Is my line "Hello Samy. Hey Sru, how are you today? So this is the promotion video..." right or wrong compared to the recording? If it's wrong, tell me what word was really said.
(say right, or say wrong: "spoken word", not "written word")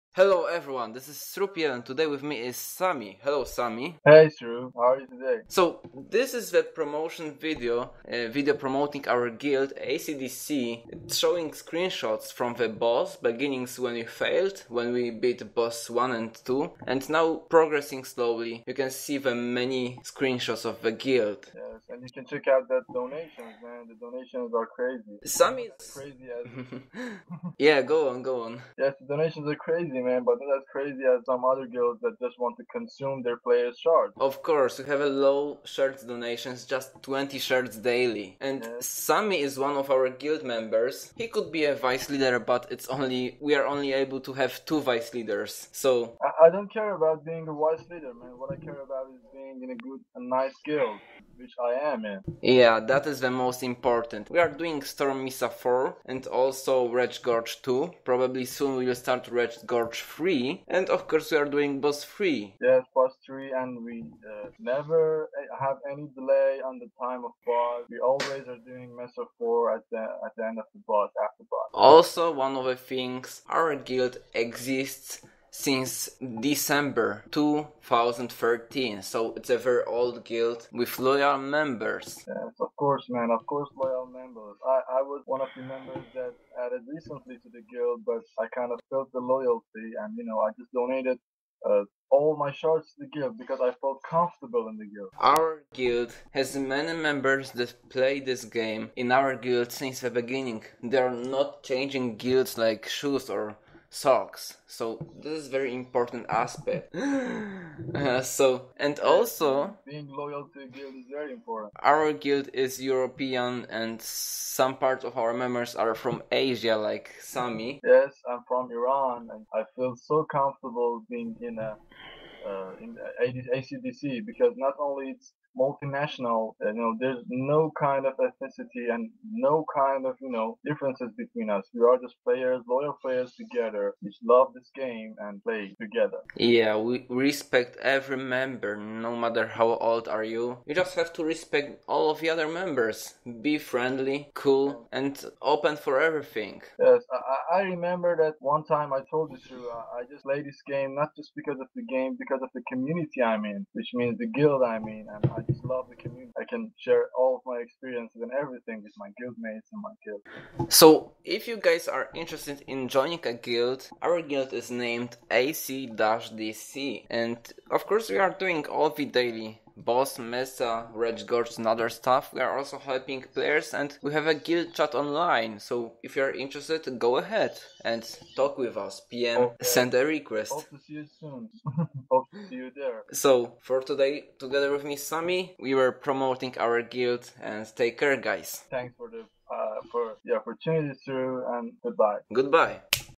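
right.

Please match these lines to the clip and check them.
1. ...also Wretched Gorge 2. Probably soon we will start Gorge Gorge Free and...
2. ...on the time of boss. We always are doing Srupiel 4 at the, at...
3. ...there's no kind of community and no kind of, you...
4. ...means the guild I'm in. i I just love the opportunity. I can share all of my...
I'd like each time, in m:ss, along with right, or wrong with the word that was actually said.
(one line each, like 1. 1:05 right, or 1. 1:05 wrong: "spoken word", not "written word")
1. 0:56 wrong: "Wretched", not "Gorge"
2. 1:06 wrong: "Mesa", not "Srupiel"
3. 2:06 wrong: "ethnicity", not "community"
4. 2:33 wrong: "community", not "opportunity".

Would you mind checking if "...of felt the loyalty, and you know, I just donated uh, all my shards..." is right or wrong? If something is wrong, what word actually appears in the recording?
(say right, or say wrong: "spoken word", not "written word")
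right.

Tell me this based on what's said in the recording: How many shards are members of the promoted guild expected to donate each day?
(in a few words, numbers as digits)
20 shards.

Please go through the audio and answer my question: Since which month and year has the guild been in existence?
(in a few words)
December 2013.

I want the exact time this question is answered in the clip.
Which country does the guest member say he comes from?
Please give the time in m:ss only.
1:58.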